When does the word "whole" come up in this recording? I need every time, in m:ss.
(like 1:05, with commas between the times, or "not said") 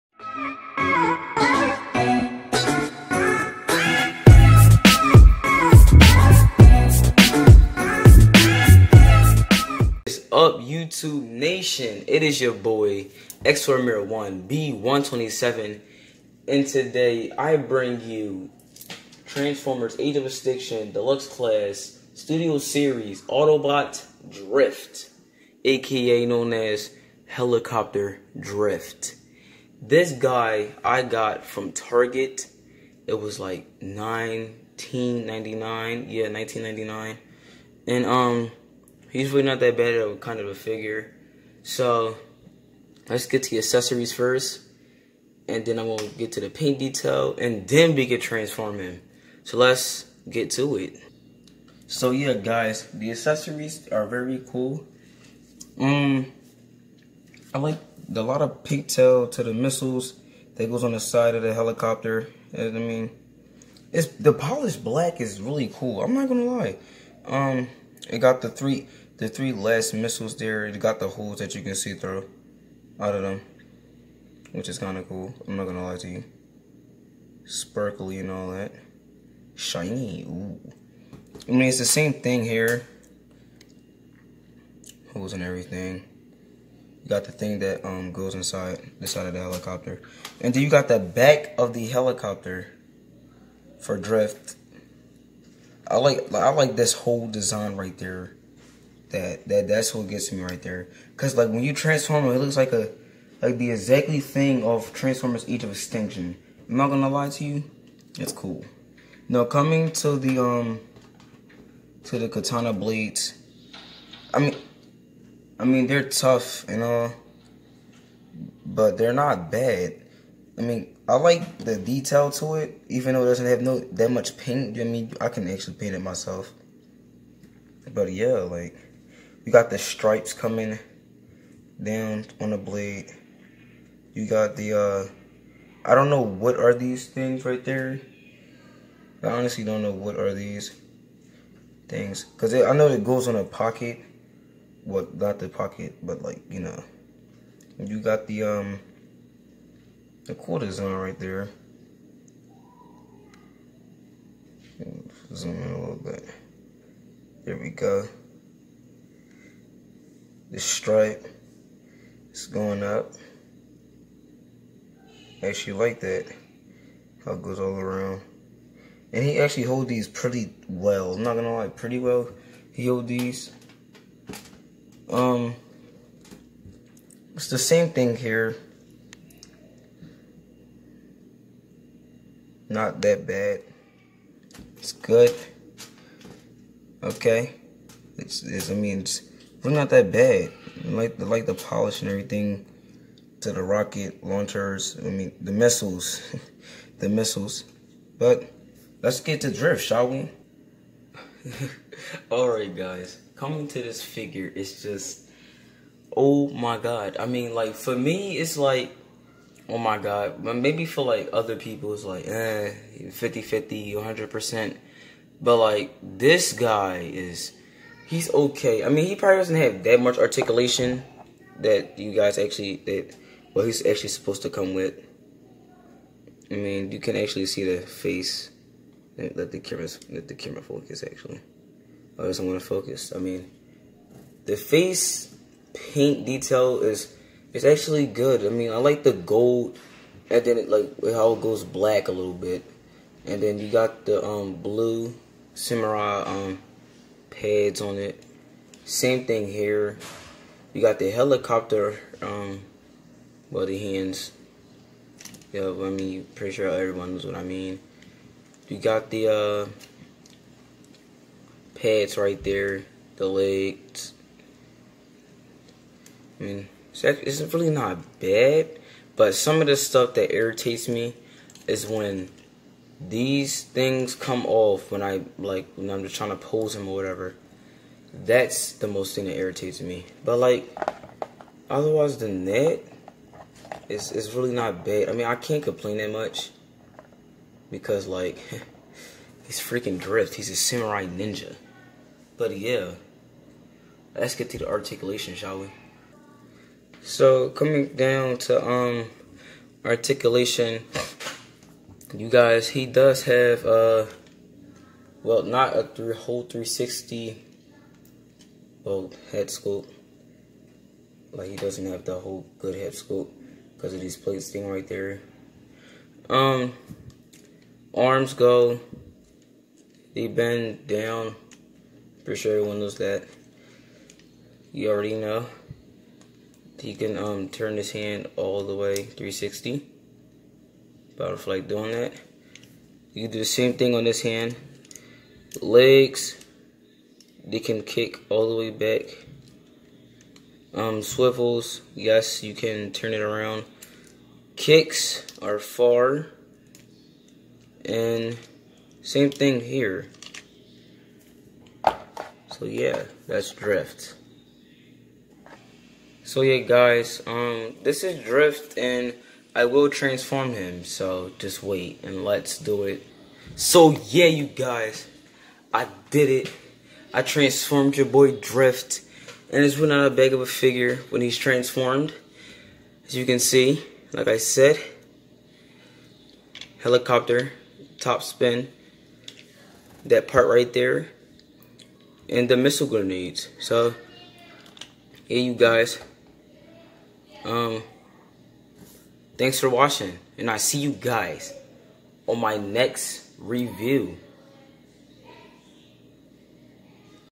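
1:36, 5:06, 5:12.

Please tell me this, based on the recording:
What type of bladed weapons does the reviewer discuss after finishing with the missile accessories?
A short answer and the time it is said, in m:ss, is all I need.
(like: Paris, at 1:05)
Katana blades, at 1:52.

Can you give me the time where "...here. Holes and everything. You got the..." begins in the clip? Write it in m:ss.
1:22.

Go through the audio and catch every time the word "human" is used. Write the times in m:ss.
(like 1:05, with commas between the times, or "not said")
not said.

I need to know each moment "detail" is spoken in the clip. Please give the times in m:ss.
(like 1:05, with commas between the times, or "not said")
0:46, 2:01, 3:56.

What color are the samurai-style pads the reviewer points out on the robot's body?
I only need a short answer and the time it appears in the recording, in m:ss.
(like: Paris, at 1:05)
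Blue, at 4:04.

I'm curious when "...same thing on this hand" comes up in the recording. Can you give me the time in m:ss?
5:33.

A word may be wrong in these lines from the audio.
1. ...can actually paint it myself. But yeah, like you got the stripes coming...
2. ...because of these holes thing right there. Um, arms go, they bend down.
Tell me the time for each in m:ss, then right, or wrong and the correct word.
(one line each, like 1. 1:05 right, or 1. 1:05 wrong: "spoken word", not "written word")
1. 2:05 right
2. 5:13 wrong: "plates", not "holes".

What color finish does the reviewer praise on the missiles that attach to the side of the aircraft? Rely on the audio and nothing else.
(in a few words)
Polished black.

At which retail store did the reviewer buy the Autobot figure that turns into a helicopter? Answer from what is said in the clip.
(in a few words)
Target.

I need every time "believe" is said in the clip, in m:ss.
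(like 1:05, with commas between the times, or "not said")
not said.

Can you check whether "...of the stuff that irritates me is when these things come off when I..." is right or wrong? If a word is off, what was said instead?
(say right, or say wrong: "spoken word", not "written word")
right.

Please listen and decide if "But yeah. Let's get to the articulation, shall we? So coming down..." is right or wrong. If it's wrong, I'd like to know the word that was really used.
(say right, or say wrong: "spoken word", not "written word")
right.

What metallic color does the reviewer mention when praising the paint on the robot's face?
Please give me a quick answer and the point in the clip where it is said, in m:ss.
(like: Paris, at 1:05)
Gold, at 3:59.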